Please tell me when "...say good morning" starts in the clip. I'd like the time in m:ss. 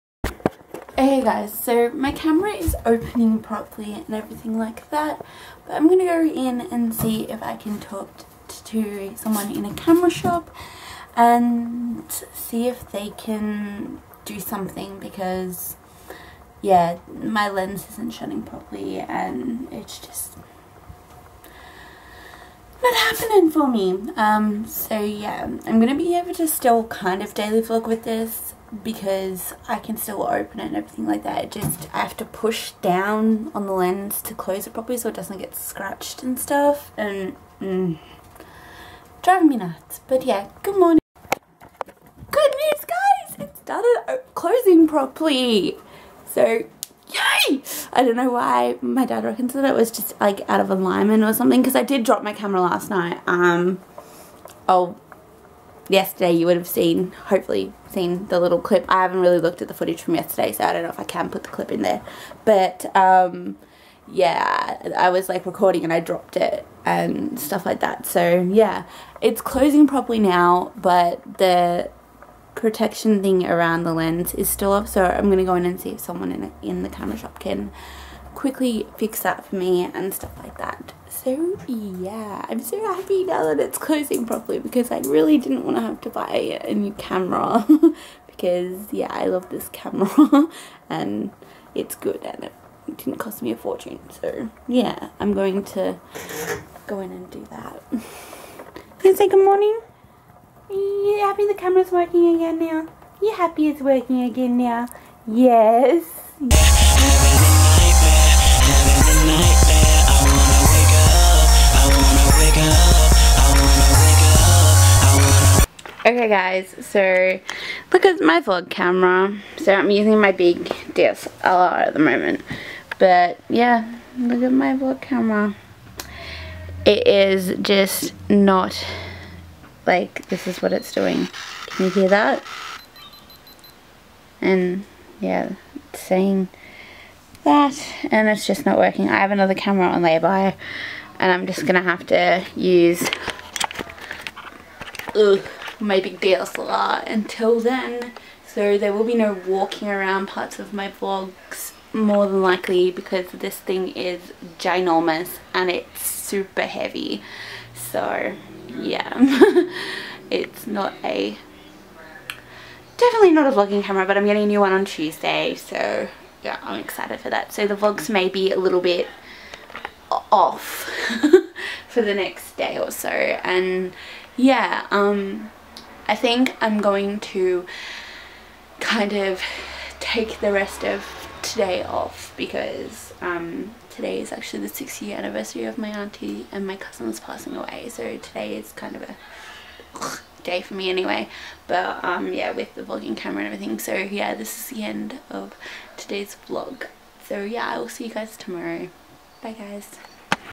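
1:39.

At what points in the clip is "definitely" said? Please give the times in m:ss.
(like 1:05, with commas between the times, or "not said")
2:42.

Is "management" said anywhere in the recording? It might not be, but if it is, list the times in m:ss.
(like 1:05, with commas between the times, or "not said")
not said.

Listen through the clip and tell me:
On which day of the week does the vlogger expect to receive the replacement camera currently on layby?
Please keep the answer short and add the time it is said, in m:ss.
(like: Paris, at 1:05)
Tuesday, at 2:44.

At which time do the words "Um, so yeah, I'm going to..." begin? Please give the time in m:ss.
0:24.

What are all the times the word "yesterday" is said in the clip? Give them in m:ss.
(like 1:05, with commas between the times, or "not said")
0:55, 1:00.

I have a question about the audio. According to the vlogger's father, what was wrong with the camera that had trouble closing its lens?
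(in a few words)
Out of alignment.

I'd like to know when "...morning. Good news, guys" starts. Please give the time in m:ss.
0:40.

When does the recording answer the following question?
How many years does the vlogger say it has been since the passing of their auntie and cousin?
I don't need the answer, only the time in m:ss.
3:04.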